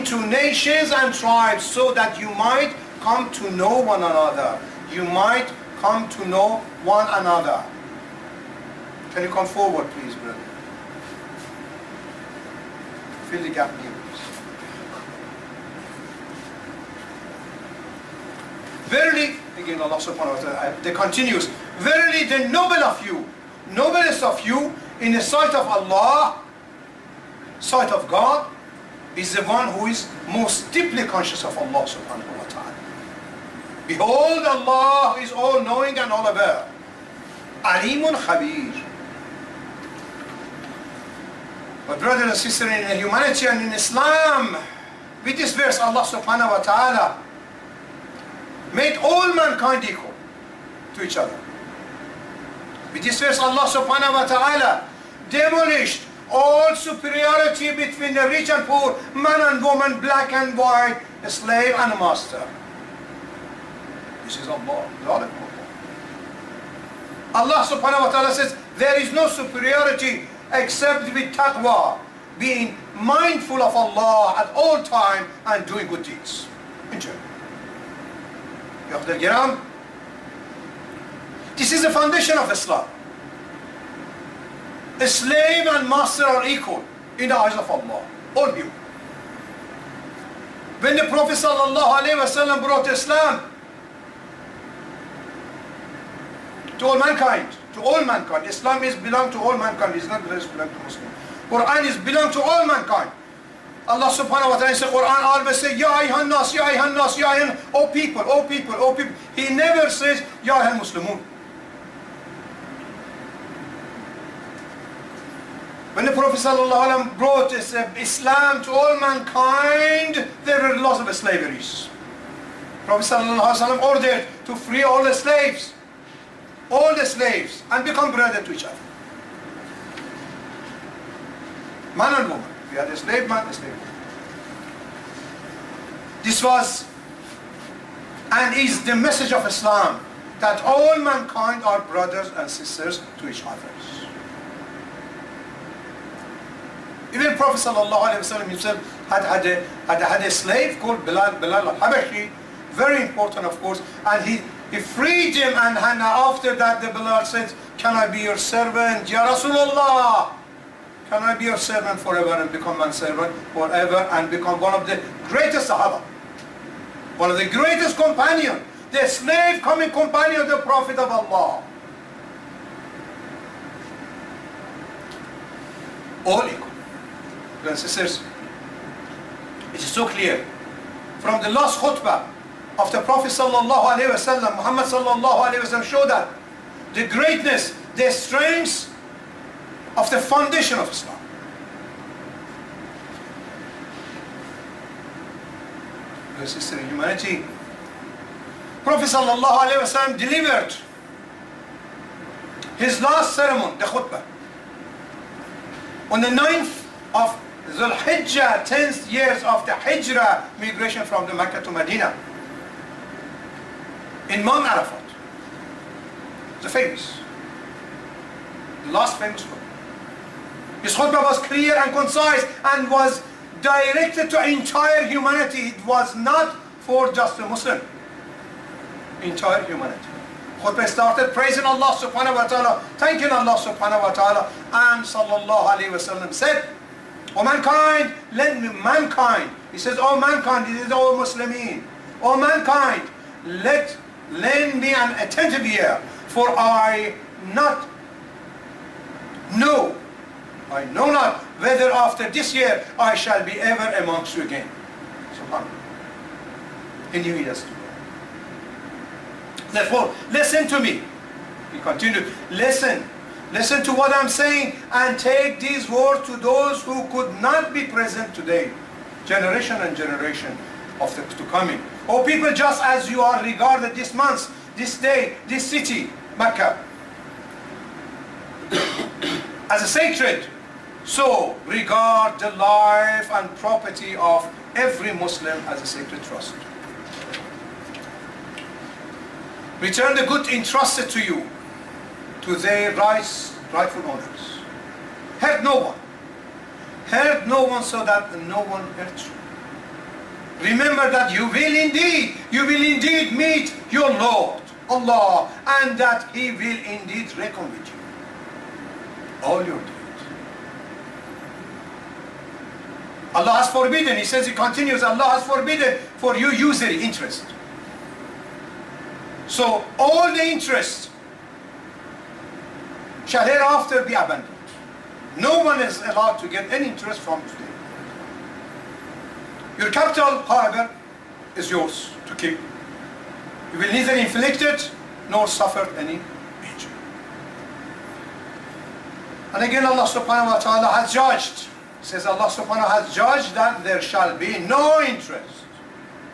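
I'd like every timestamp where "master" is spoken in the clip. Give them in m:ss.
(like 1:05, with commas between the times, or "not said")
1:01, 1:25.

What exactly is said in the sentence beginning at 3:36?
The famous, the last famous book.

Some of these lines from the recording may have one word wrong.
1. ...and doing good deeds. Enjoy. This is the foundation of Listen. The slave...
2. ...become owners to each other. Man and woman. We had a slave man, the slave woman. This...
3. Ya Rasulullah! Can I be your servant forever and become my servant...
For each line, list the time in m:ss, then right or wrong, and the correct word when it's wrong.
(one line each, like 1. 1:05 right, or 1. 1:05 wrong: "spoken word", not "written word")
1. 1:15 wrong: "Islam", not "Listen"
2. 2:07 wrong: "brothers", not "owners"
3. 2:39 right.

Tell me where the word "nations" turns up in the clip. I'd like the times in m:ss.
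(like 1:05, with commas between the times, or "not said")
0:00.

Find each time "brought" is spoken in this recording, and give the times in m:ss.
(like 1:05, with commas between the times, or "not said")
1:32, 1:57.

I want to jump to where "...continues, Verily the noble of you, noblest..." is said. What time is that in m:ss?
0:20.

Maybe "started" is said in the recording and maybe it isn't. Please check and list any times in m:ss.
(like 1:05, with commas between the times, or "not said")
3:50.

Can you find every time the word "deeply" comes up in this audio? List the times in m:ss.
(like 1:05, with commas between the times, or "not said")
0:30.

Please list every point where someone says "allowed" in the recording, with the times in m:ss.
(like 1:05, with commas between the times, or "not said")
5:26.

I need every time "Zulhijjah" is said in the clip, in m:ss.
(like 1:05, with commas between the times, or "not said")
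3:27.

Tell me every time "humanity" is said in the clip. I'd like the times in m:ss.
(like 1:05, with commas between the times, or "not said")
0:42, 3:16, 3:45, 3:49.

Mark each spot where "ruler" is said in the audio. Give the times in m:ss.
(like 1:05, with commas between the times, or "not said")
not said.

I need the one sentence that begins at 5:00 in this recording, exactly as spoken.
Remember that you will indeed, you will indeed meet your Lord, Allah, and that He will indeed reckon with you.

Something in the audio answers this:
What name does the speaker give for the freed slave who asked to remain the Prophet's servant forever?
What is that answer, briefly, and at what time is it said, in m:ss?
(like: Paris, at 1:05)
Bilal al-Habashi, at 2:31.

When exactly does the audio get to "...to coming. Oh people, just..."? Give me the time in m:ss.
4:31.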